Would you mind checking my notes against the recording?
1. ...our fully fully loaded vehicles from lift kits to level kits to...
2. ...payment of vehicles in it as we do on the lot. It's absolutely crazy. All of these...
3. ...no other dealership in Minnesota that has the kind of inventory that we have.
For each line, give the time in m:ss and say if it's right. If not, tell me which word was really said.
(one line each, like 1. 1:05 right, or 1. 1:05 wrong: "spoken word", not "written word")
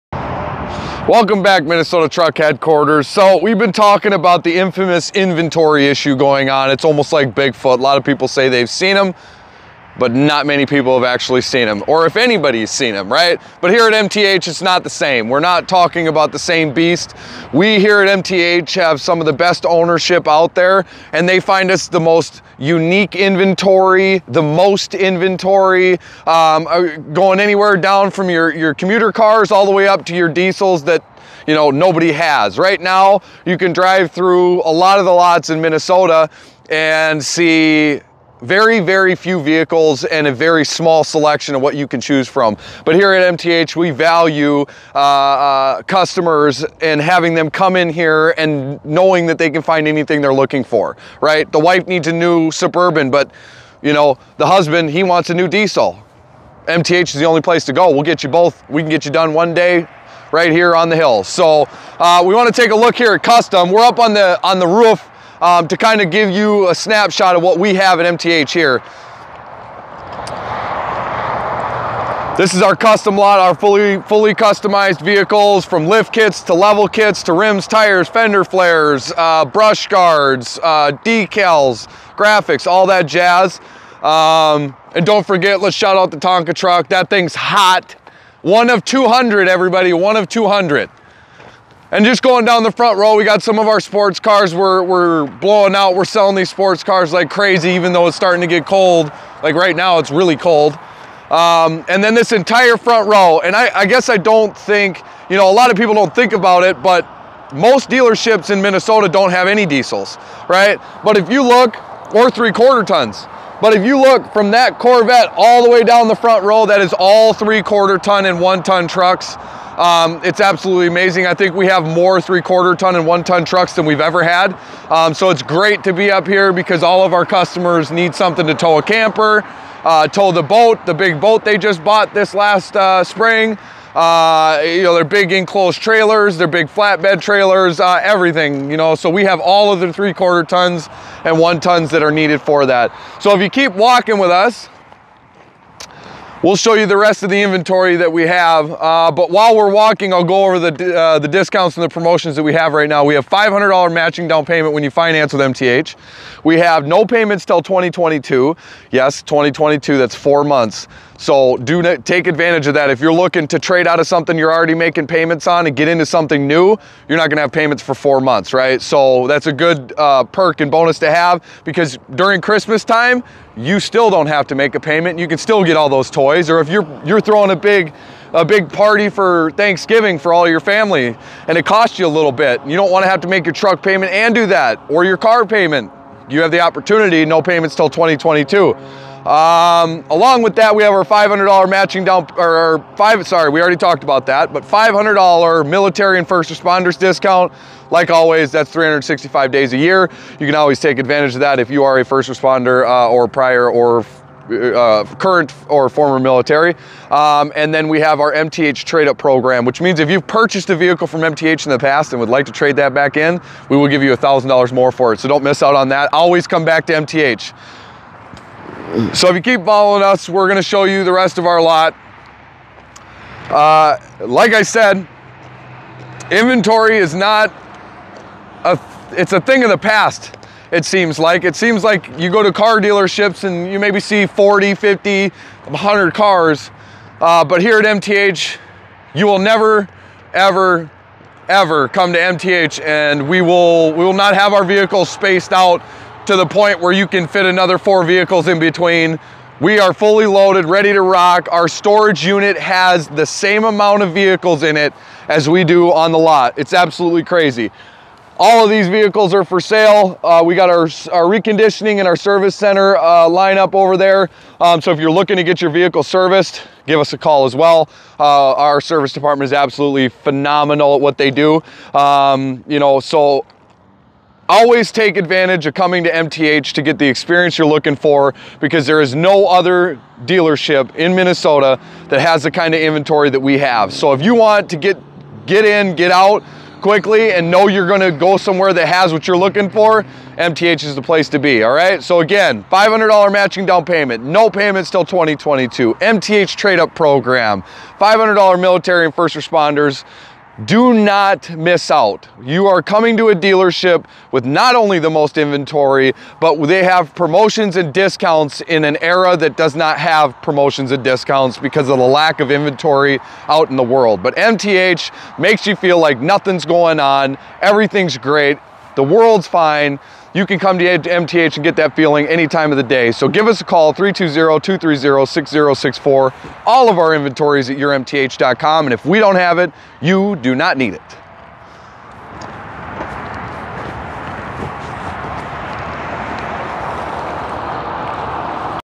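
1. 1:13 wrong: "customized", not "loaded"
2. 4:13 wrong: "amount", not "payment"
3. 4:39 right.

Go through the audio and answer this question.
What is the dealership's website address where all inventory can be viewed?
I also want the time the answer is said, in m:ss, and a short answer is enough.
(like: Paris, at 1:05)
yourmth.com, at 5:27.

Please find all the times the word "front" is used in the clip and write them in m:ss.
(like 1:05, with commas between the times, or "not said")
1:32, 1:42, 1:56.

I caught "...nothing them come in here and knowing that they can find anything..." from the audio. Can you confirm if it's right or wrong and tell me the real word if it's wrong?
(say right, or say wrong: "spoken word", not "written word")
wrong: "having", not "nothing".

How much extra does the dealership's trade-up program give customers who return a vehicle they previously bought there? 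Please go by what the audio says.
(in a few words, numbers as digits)
$1,000.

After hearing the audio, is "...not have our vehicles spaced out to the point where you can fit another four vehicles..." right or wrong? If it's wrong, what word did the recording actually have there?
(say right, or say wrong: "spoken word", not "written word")
right.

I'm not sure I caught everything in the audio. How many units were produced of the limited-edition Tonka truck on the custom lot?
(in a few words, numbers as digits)
200.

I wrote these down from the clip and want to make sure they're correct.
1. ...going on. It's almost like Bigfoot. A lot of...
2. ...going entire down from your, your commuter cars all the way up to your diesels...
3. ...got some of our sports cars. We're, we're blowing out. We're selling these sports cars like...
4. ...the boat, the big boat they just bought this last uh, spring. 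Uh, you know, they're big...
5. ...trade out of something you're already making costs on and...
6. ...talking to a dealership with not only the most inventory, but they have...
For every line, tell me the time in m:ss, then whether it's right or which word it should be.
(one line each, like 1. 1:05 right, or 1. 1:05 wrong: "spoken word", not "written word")
1. 0:06 right
2. 0:27 wrong: "anywhere", not "entire"
3. 1:33 right
4. 2:10 right
5. 2:43 wrong: "payments", not "costs"
6. 5:02 wrong: "coming", not "talking".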